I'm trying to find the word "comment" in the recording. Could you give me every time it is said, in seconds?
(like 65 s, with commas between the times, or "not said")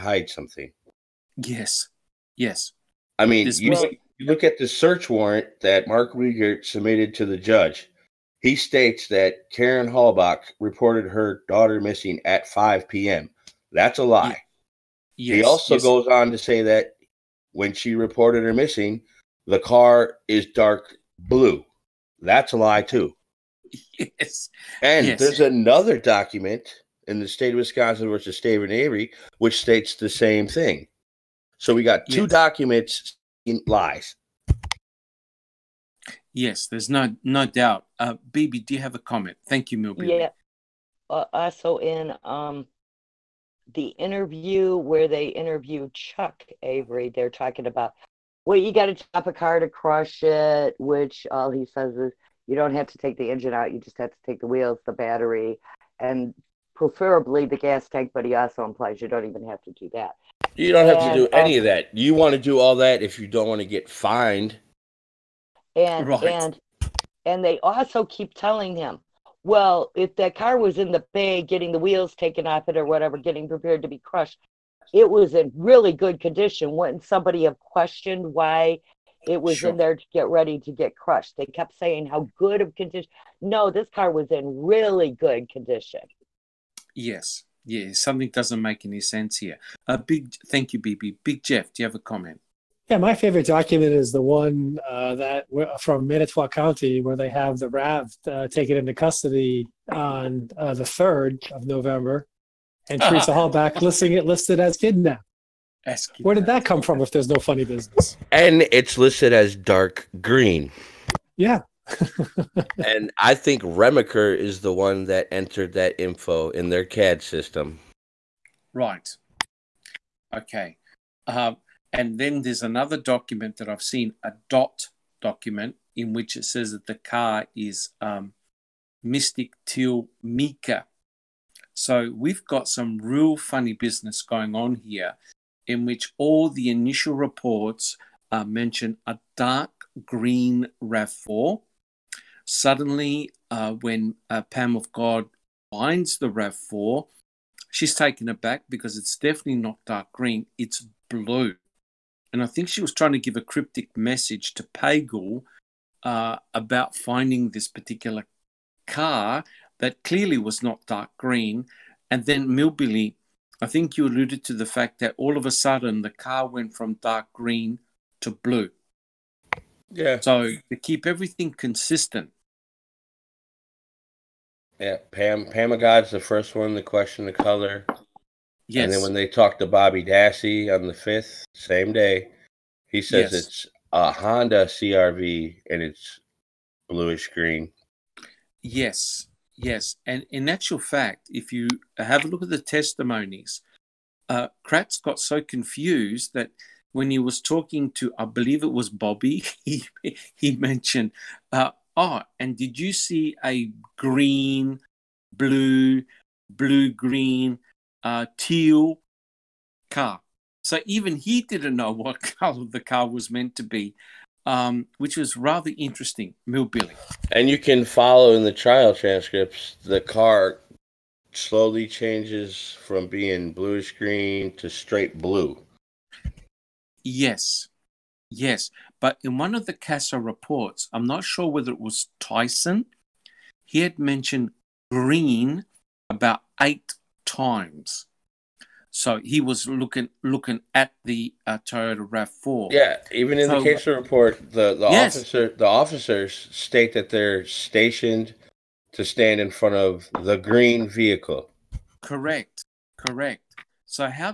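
38 s, 91 s.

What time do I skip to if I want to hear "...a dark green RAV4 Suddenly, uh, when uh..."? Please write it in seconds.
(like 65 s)
139 s.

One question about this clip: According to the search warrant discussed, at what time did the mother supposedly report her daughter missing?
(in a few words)
5 p.m.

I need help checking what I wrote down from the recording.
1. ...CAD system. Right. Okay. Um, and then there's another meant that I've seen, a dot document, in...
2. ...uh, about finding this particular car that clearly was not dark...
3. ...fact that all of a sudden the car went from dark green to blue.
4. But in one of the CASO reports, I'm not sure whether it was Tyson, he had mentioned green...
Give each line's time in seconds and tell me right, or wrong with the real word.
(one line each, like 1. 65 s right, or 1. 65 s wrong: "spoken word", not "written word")
1. 116 s wrong: "document", not "meant"
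2. 156 s right
3. 164 s right
4. 229 s right.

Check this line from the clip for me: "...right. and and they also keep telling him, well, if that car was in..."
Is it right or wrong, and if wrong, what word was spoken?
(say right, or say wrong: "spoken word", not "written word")
right.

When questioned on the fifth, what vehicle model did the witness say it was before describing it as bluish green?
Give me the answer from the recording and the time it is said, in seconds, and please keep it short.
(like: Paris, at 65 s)
Honda CRV, at 184 s.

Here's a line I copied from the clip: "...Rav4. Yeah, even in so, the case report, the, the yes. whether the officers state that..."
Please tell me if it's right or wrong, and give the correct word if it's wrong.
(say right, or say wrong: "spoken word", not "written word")
wrong: "officer", not "whether".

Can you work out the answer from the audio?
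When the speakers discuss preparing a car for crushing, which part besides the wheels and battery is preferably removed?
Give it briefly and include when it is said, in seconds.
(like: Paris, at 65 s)
the gas tank, at 57 s.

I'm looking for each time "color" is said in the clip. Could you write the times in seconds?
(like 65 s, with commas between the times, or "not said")
177 s, 212 s.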